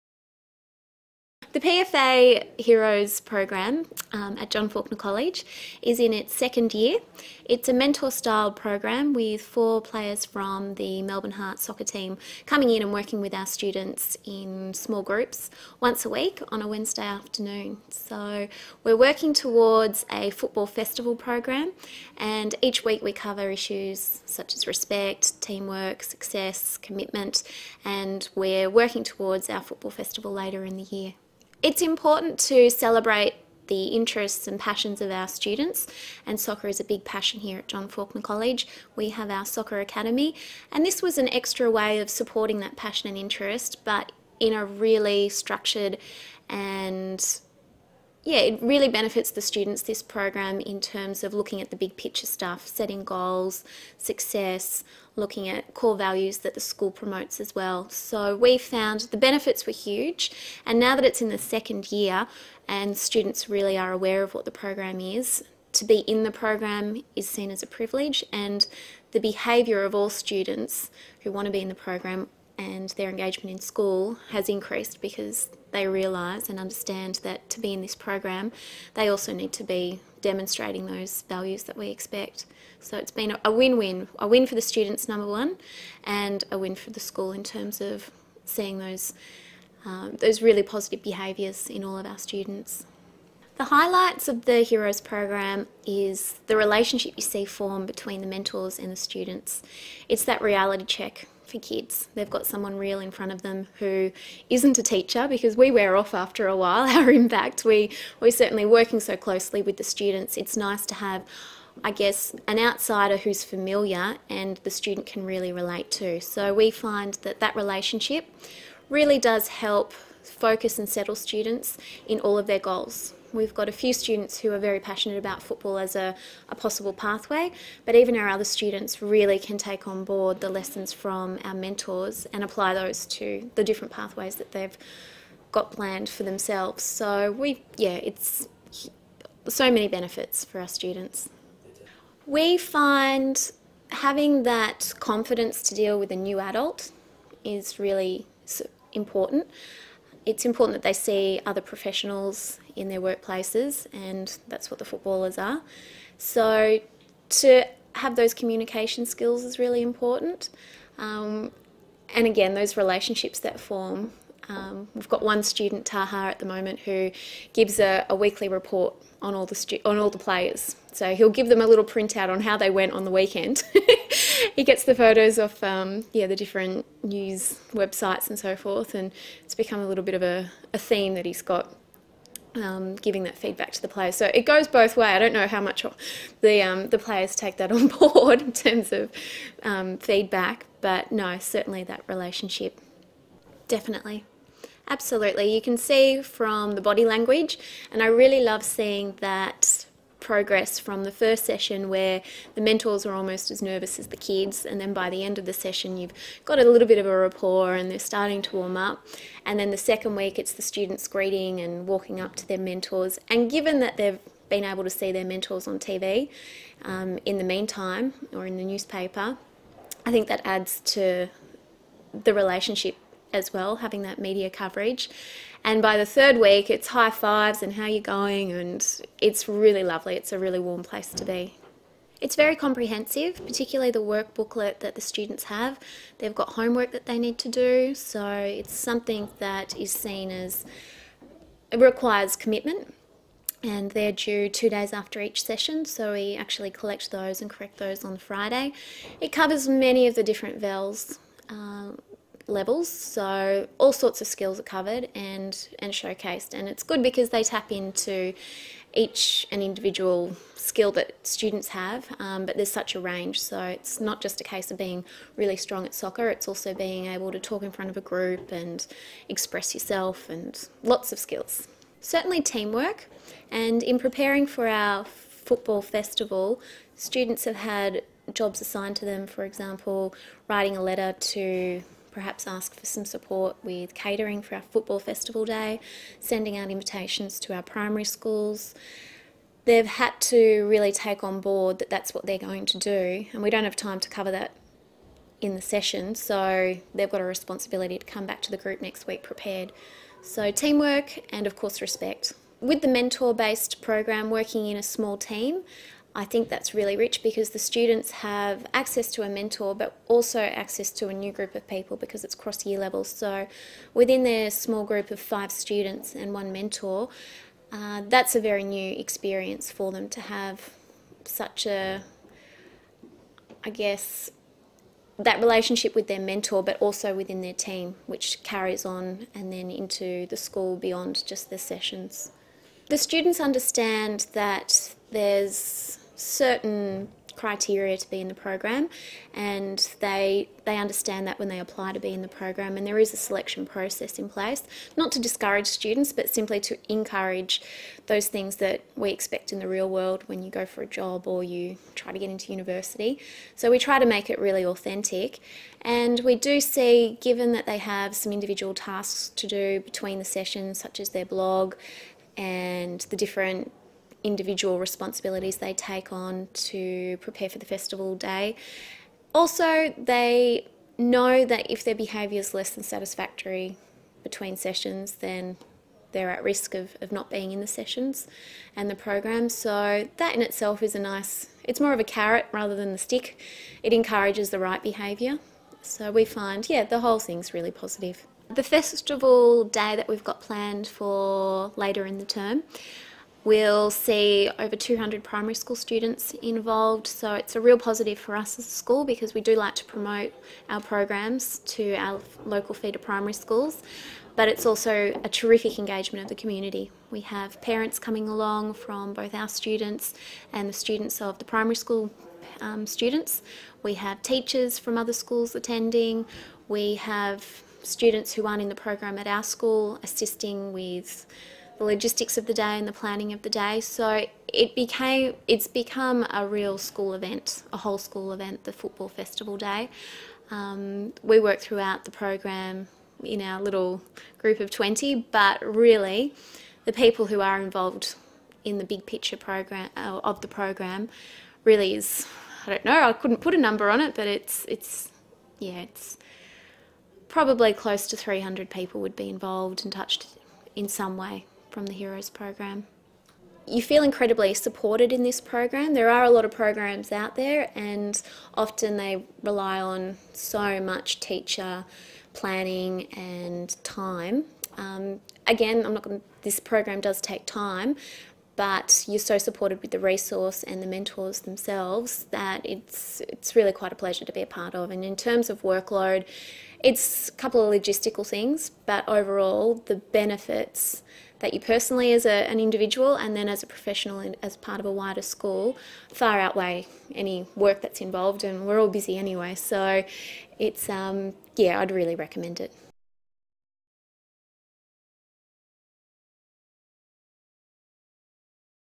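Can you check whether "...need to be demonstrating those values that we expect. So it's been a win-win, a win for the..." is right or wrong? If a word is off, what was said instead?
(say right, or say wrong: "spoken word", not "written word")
right.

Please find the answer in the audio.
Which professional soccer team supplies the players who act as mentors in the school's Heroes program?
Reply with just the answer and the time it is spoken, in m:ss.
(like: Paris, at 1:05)
Melbourne Heart, at 0:11.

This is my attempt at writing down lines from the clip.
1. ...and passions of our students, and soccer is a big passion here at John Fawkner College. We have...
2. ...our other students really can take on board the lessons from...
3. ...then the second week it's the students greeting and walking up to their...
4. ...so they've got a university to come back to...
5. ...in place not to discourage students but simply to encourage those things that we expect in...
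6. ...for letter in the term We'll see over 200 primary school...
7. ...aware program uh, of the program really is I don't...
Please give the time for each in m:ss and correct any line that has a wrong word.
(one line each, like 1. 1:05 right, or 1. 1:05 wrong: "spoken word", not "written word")
1. 0:34 right
2. 2:08 right
3. 3:29 right
4. 4:56 wrong: "responsibility", not "university"
5. 5:44 right
6. 6:30 wrong: "later", not "letter"
7. 7:19 wrong: "picture", not "aware".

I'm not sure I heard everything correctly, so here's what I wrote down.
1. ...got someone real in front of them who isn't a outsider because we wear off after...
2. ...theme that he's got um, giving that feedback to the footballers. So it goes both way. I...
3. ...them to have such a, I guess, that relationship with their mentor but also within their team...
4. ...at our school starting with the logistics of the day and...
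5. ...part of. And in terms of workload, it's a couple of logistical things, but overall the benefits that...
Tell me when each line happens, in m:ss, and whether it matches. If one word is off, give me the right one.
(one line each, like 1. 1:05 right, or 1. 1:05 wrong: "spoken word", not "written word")
1. 1:42 wrong: "teacher", not "outsider"
2. 3:00 wrong: "players", not "footballers"
3. 5:19 right
4. 6:59 wrong: "assisting", not "starting"
5. 7:54 right.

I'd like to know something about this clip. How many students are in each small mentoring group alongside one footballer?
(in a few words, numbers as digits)
5.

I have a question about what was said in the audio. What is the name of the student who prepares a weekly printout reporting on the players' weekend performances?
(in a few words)
Taha.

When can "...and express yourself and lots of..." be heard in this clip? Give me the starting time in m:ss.
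4:28.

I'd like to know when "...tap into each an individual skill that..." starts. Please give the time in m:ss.
4:17.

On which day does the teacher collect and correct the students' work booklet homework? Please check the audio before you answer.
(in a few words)
Friday.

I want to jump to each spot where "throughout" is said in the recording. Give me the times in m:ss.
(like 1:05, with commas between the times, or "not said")
7:11.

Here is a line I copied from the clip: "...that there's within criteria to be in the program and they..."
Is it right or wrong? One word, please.
wrong.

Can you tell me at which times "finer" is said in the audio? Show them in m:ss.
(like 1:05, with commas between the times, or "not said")
not said.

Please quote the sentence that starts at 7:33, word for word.
You feel incredibly supported in this program.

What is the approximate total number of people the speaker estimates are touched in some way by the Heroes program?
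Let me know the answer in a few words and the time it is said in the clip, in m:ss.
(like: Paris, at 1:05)
300, at 7:28.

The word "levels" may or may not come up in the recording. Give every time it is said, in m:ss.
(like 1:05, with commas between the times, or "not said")
4:12, 5:12.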